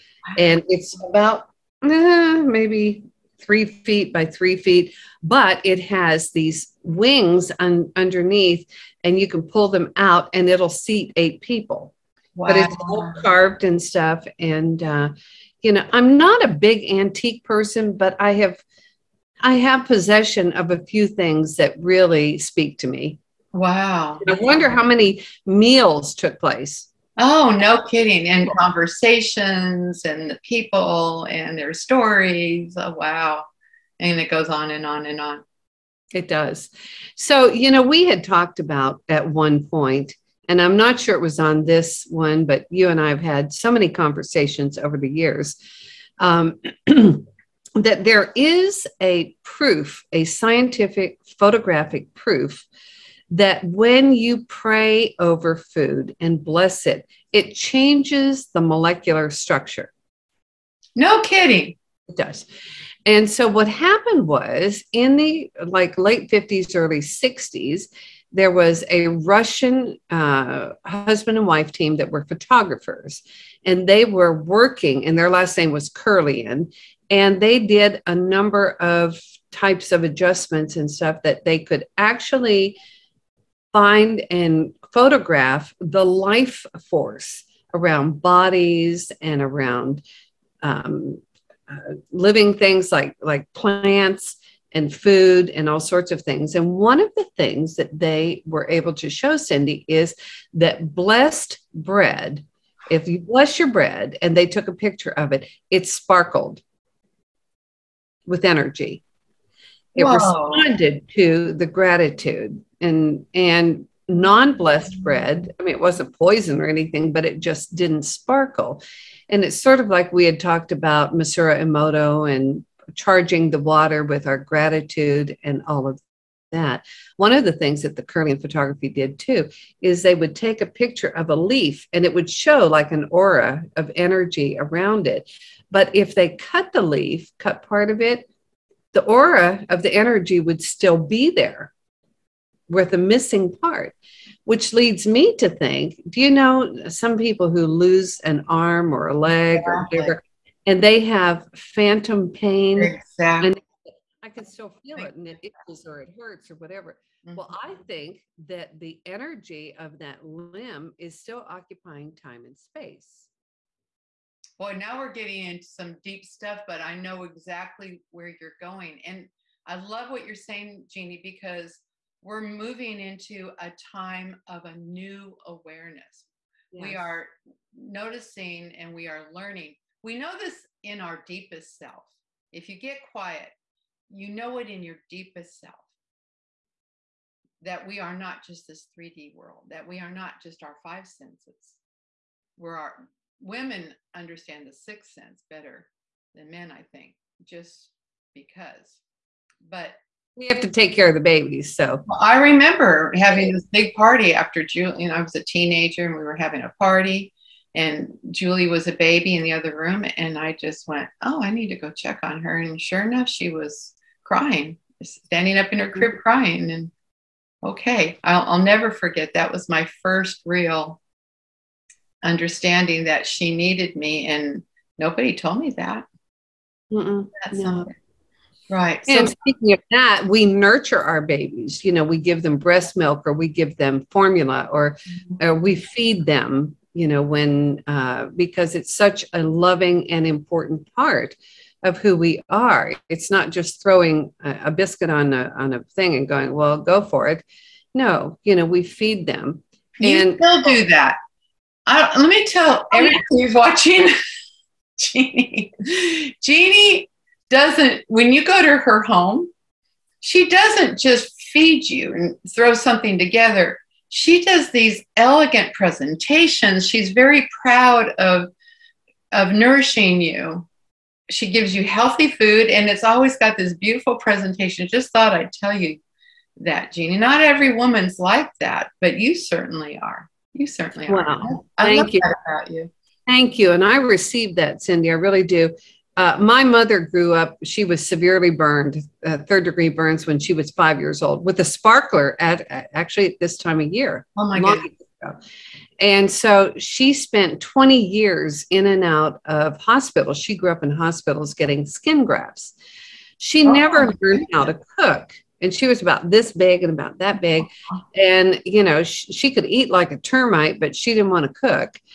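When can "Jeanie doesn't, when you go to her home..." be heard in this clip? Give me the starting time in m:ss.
4:16.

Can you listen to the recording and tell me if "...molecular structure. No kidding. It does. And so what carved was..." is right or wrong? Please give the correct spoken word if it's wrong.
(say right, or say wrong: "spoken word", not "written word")
wrong: "happened", not "carved".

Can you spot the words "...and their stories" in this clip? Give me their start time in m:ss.
0:31.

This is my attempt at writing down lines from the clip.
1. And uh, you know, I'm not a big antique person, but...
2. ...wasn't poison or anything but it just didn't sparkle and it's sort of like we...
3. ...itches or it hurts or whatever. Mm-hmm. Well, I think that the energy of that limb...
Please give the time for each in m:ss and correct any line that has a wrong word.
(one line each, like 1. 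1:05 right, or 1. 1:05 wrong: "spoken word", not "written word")
1. 0:14 right
2. 1:55 right
3. 2:35 right.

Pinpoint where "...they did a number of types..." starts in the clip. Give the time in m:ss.
1:17.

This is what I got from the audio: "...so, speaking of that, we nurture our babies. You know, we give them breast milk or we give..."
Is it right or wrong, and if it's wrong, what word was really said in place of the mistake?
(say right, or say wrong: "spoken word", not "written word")
right.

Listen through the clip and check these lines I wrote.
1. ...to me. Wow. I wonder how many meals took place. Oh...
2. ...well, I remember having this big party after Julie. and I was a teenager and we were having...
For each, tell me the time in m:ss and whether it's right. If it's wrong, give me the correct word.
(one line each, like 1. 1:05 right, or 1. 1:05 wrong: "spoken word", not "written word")
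1. 0:22 right
2. 3:22 right.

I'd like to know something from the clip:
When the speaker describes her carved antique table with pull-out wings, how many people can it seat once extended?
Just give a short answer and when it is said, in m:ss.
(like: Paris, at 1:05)
8, at 0:11.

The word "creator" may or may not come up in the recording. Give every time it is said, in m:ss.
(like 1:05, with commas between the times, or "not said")
not said.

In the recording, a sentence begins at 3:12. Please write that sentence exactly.
We're our women understand the sixth sense better than men, I think, just because.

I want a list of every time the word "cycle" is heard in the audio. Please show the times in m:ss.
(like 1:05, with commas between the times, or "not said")
not said.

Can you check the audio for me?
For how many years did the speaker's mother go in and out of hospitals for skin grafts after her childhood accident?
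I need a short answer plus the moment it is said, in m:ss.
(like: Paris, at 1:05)
20, at 4:57.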